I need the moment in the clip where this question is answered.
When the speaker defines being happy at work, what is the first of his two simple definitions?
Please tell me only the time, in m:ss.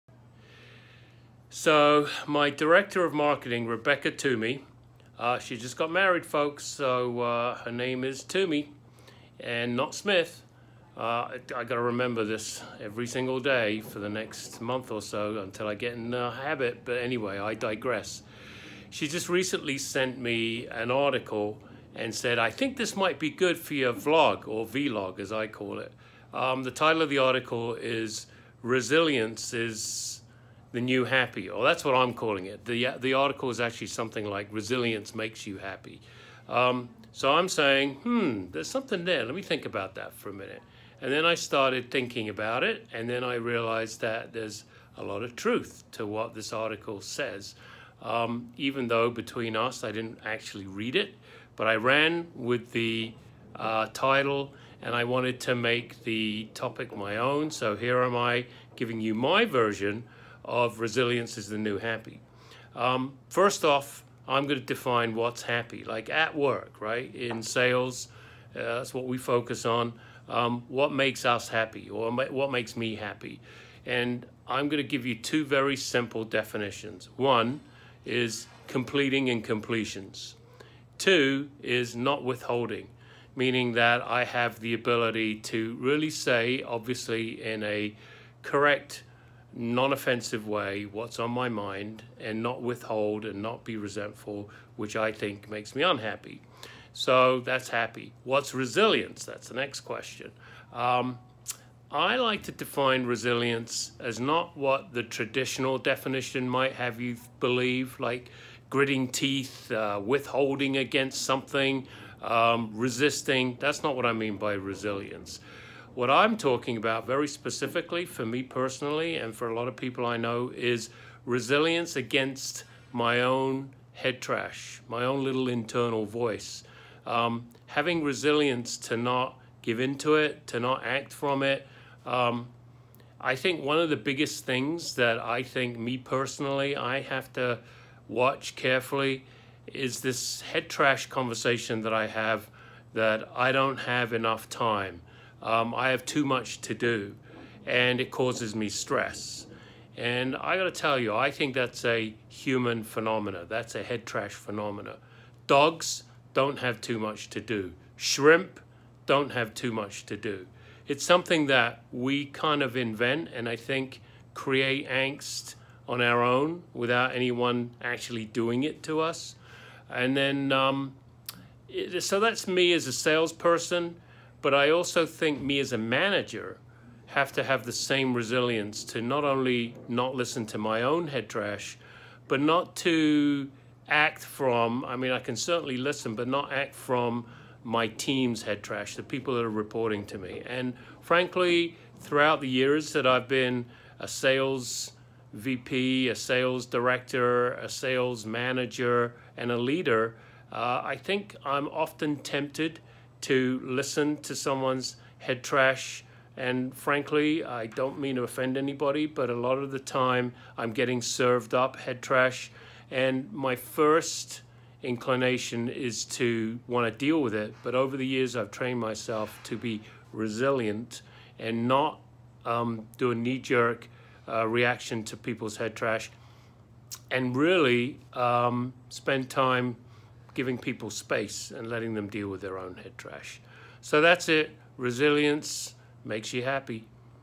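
1:18.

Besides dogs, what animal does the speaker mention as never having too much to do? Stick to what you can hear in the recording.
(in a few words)
Shrimp.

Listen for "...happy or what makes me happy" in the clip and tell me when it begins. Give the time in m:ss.
1:11.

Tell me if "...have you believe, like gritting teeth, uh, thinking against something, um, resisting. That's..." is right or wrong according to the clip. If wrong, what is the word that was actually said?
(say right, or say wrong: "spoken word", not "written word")
wrong: "withholding", not "thinking".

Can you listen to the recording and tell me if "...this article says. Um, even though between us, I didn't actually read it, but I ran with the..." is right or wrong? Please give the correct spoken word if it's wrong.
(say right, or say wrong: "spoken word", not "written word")
right.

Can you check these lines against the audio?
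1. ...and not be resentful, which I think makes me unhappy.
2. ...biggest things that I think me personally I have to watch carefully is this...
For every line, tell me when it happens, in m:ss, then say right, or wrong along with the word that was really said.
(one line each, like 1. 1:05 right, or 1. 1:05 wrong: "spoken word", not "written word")
1. 1:33 right
2. 2:13 right.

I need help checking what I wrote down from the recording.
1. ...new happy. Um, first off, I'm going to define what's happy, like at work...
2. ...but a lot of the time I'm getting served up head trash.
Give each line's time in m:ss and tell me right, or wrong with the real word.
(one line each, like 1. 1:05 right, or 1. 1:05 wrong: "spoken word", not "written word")
1. 1:01 right
2. 3:29 right.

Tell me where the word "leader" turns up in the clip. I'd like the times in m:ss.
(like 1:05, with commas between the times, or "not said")
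3:19.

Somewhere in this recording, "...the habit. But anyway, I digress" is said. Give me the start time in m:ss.
0:16.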